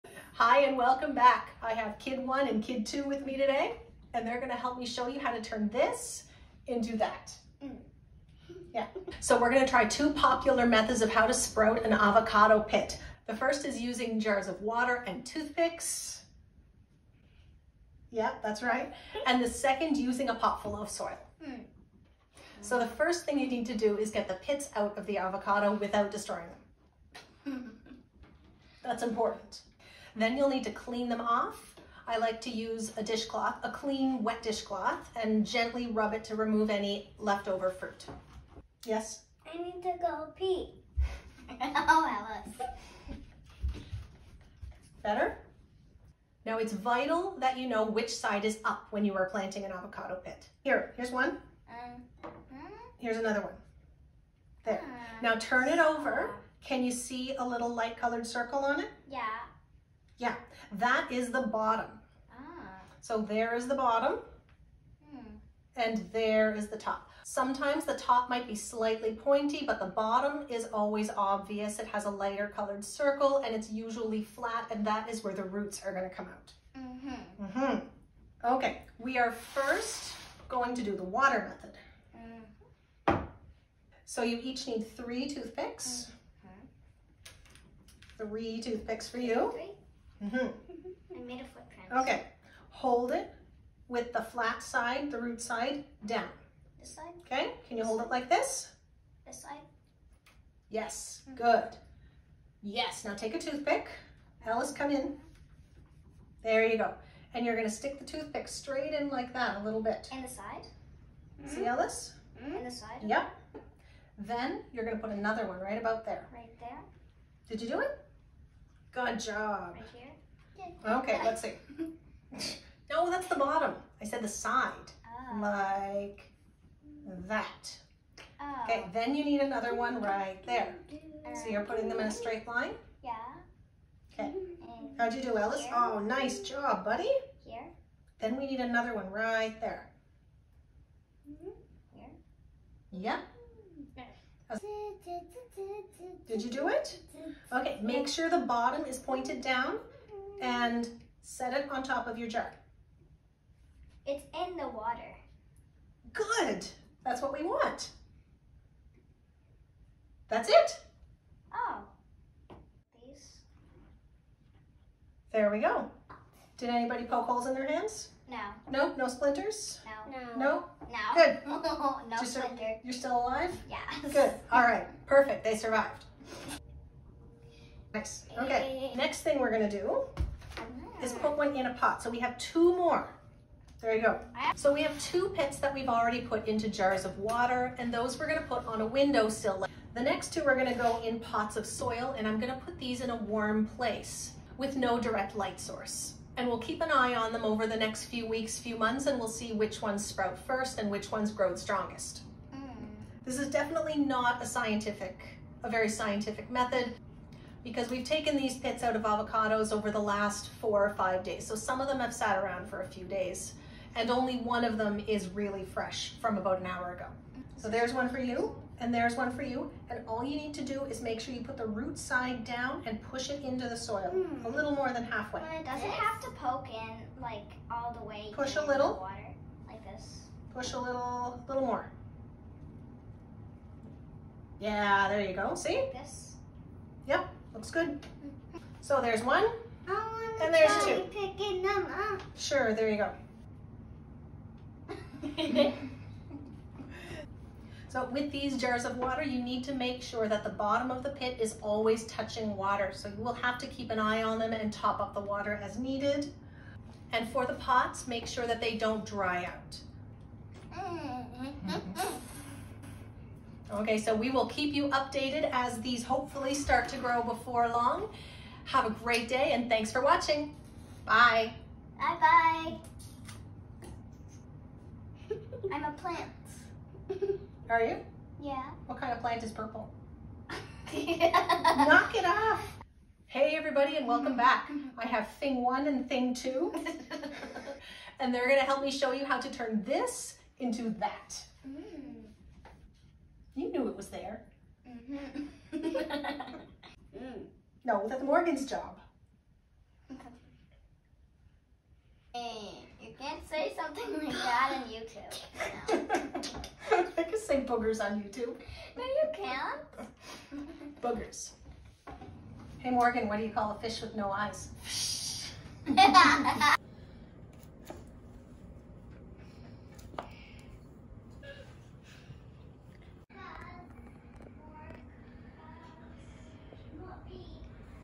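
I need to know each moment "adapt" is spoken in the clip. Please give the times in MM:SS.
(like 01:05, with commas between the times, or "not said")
not said.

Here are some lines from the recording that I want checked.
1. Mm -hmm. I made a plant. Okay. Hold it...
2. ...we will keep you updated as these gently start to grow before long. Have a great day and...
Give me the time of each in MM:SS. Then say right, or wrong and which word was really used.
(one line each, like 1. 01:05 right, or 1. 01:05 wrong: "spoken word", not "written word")
1. 01:30 wrong: "footprint", not "plant"
2. 04:24 wrong: "hopefully", not "gently".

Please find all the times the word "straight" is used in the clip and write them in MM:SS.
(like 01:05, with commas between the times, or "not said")
01:48, 02:12.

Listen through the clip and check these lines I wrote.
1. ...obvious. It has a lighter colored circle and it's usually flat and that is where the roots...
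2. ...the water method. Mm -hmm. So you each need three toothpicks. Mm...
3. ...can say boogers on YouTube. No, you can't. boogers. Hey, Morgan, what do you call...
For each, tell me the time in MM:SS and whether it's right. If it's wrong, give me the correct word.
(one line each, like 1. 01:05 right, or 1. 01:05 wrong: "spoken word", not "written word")
1. 01:11 right
2. 01:21 right
3. 05:07 right.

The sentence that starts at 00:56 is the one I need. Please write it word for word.
Can you see a little light colored circle on it?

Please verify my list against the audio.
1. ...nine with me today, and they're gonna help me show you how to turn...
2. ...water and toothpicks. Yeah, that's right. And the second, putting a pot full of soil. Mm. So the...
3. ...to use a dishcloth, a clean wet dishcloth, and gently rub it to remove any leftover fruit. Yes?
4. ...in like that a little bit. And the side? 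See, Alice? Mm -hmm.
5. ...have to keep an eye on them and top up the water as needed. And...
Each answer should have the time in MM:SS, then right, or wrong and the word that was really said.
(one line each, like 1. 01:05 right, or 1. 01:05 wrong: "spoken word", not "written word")
1. 00:02 wrong: "two", not "nine"
2. 00:14 wrong: "using", not "putting"
3. 00:32 right
4. 01:49 right
5. 04:13 right.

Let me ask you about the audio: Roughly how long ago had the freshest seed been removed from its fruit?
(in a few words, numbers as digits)
about an hour ago.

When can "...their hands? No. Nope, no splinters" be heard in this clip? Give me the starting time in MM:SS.
02:47.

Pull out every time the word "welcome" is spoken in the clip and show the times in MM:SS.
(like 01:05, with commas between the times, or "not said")
00:00, 04:44.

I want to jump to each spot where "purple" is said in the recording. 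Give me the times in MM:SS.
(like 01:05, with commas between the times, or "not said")
04:39.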